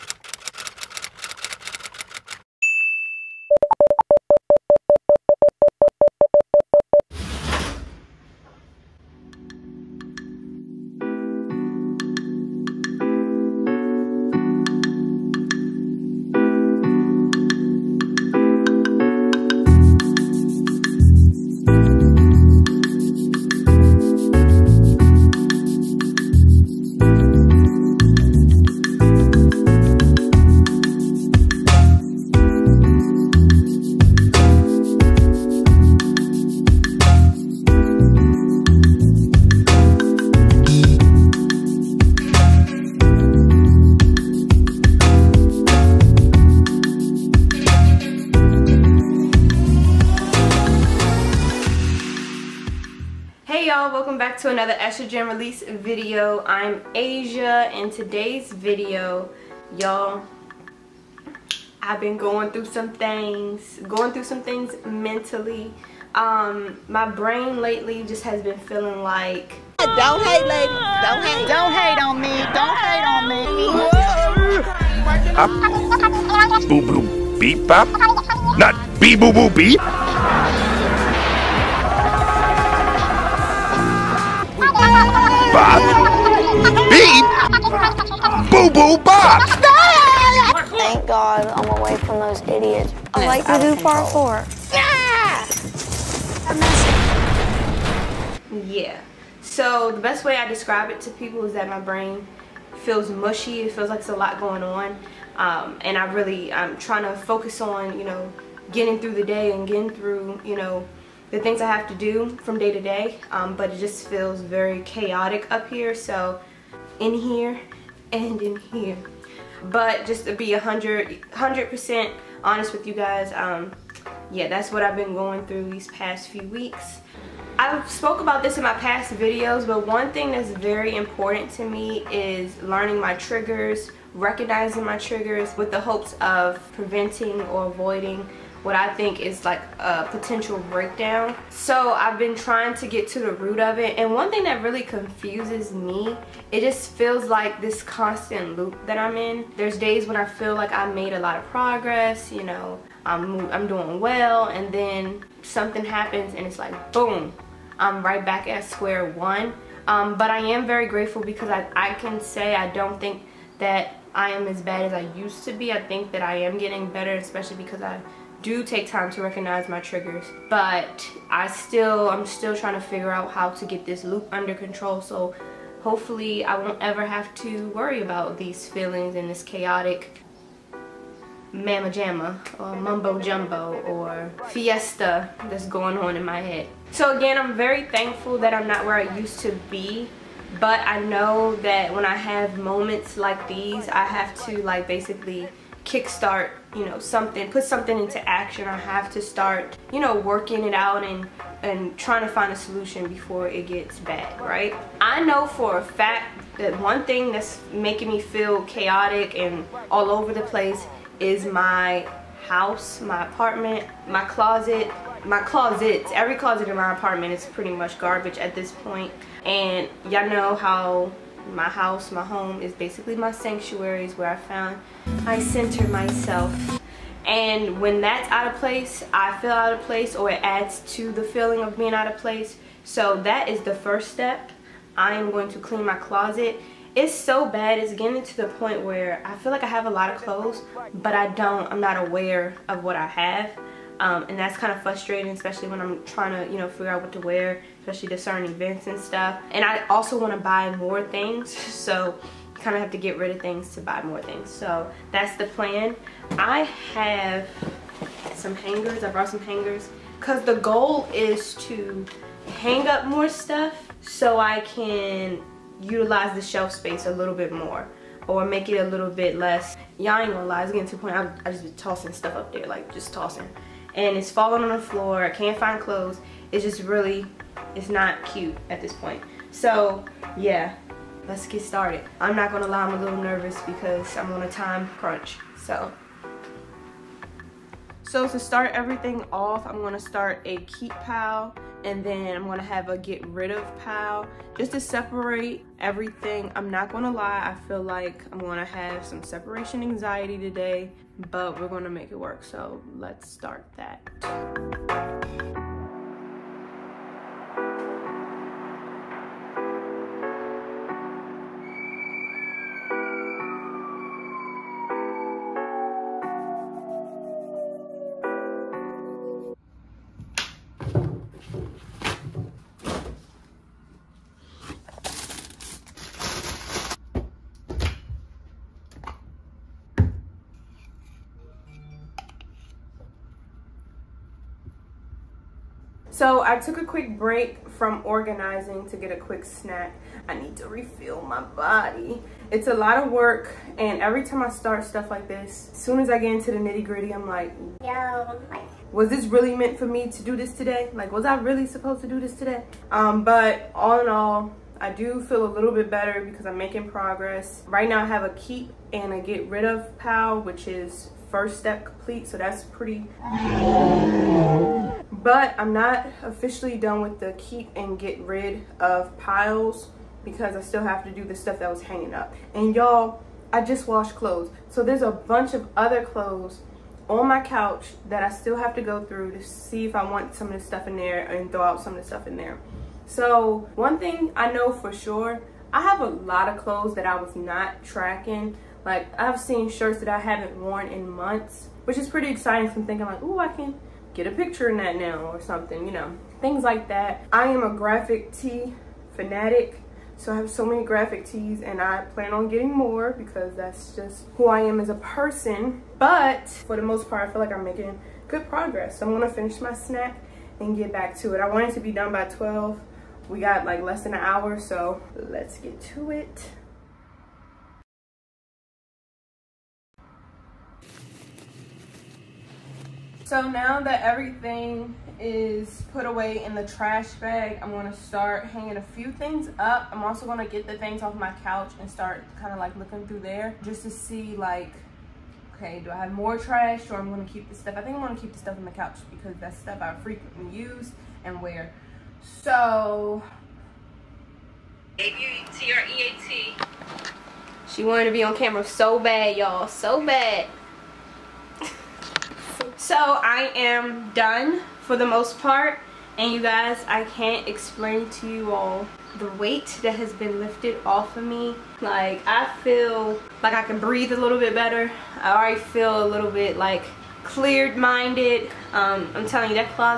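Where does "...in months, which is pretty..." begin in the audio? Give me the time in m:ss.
6:30.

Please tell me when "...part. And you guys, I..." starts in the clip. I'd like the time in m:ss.
7:35.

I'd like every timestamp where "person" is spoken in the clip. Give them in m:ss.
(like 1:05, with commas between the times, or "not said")
6:44.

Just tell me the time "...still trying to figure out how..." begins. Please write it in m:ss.
2:52.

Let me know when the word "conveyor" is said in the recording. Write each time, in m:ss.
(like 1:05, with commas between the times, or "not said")
not said.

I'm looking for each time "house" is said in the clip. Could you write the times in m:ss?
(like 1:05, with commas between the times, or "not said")
3:32, 3:41.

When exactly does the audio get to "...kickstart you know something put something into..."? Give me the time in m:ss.
3:15.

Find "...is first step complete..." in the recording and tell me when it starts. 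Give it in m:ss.
6:00.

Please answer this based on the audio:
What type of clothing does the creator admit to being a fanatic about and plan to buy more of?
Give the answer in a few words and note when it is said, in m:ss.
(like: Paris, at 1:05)
graphic tees, at 6:37.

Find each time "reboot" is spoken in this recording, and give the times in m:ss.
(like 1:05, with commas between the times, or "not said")
not said.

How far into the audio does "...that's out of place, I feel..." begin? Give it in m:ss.
3:48.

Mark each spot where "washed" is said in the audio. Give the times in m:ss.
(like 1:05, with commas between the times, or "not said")
6:13.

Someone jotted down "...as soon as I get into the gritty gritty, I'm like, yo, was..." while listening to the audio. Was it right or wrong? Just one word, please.
wrong.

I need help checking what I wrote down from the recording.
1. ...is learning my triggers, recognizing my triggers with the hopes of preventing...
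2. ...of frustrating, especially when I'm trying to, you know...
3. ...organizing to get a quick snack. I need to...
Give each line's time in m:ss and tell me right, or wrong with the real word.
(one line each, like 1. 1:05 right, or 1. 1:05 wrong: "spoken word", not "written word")
1. 2:12 right
2. 4:04 right
3. 5:38 right.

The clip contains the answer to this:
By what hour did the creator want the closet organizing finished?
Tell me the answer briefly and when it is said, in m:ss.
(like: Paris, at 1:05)
12, at 6:52.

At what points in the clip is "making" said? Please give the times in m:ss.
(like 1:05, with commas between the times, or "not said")
3:27, 5:56, 6:47.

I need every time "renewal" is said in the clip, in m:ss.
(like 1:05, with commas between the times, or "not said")
not said.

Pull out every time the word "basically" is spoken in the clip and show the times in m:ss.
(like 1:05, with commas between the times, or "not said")
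3:14, 3:42.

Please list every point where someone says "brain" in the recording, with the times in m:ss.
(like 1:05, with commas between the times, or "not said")
1:07, 1:41.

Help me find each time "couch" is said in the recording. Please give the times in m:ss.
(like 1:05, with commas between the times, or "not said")
6:17, 7:11, 7:18.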